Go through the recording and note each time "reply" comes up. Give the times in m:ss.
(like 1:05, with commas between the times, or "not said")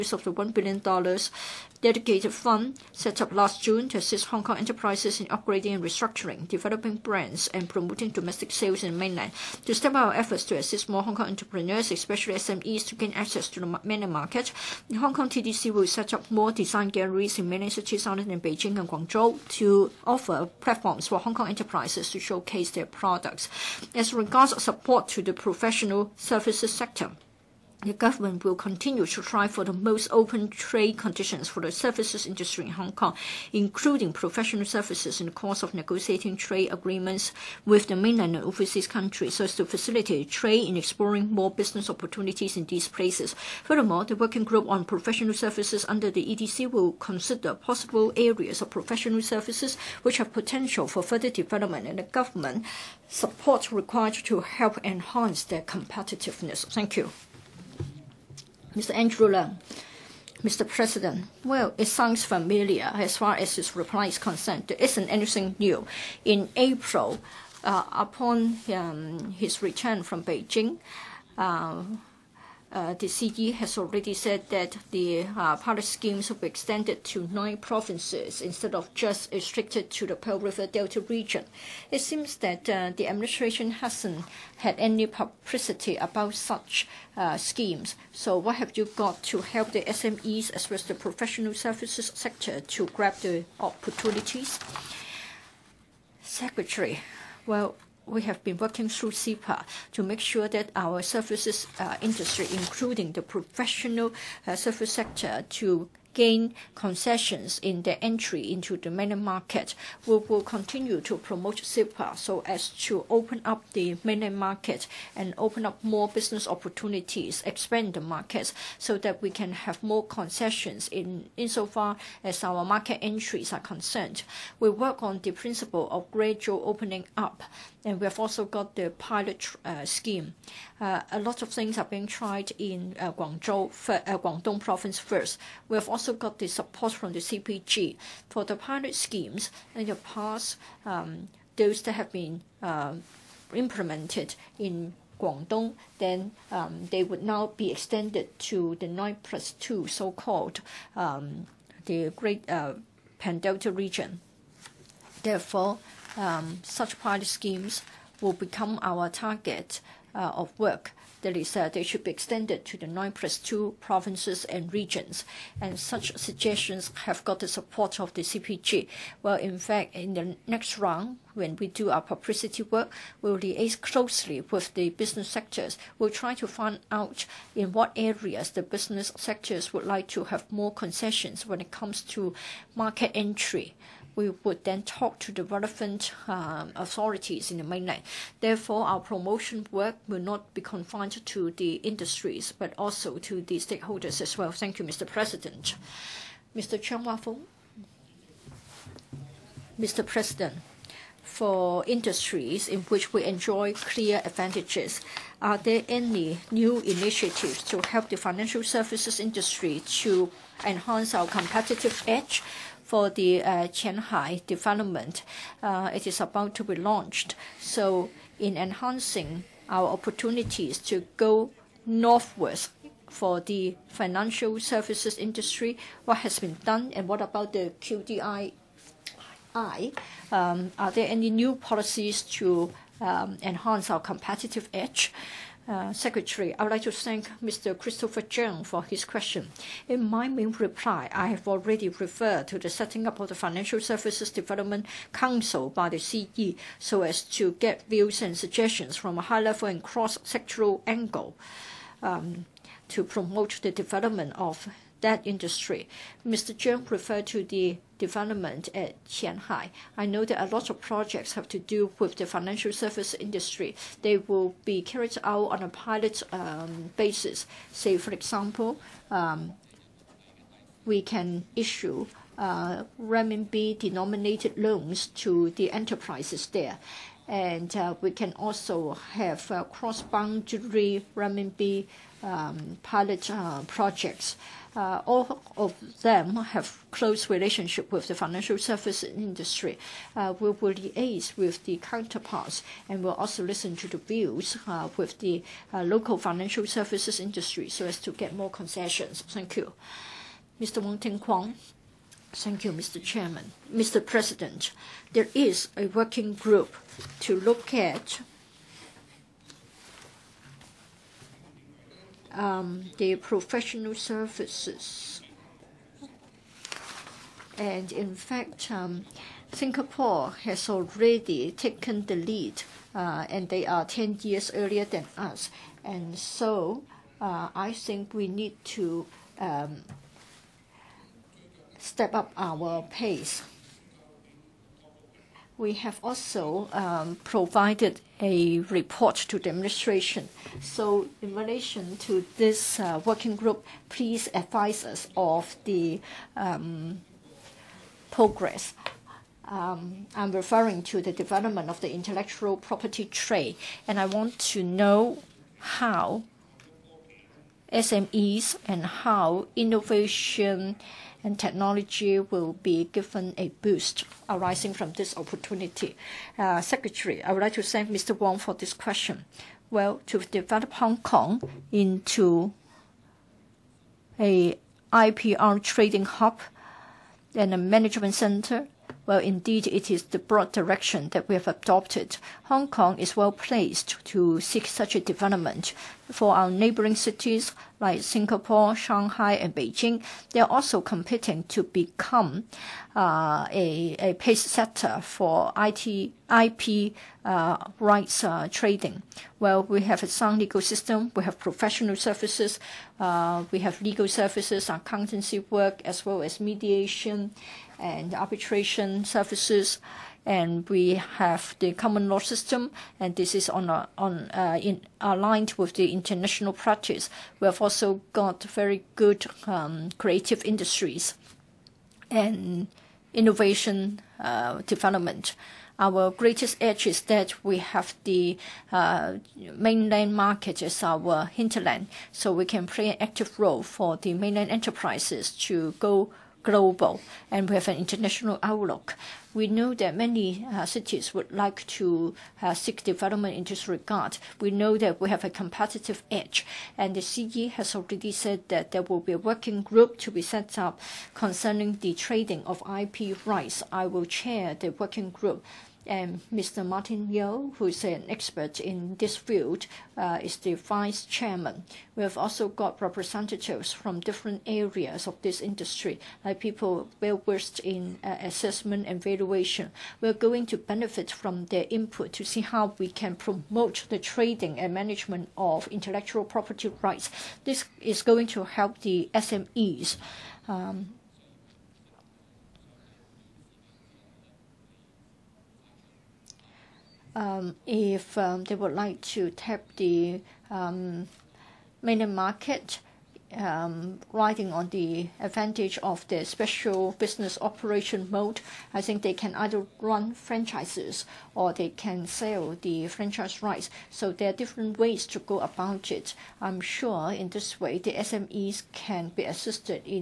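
1:03, 4:00.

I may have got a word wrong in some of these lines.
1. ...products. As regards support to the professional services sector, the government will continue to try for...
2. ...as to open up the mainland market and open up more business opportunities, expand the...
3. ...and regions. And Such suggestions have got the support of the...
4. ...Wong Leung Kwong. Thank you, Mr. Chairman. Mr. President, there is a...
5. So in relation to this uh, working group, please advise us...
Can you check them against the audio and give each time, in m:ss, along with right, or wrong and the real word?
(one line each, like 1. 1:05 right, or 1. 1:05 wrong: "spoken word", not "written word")
1. 0:22 right
2. 1:52 right
3. 2:44 right
4. 5:00 wrong: "Ting", not "Leung"
5. 5:40 right.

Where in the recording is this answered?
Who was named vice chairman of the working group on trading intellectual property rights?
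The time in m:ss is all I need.
7:36.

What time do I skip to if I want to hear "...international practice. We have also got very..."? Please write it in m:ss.
6:55.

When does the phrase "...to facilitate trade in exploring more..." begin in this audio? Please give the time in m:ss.
0:39.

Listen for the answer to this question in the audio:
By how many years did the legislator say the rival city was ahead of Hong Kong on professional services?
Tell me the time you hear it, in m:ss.
5:23.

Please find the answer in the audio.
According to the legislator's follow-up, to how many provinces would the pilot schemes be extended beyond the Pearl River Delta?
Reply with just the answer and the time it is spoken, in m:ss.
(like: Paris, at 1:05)
9, at 1:17.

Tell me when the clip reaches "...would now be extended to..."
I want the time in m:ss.
2:27.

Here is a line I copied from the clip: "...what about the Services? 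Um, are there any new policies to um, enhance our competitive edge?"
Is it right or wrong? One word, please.
wrong.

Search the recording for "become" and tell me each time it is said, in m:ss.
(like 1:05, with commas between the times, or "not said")
2:38, 6:31.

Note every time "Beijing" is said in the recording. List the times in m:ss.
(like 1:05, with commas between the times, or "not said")
0:18, 1:10, 6:29.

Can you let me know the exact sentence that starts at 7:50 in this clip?
We're going to benefit from their input to see how we can promote the trading and management of intellectual property rights.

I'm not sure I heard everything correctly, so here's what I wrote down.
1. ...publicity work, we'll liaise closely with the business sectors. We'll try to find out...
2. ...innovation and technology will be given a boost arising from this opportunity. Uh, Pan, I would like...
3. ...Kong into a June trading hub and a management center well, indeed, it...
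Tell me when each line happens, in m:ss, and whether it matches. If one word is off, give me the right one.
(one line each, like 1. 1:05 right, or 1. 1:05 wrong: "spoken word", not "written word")
1. 2:52 right
2. 5:59 wrong: "Secretary", not "Pan"
3. 6:10 wrong: "IPR", not "June".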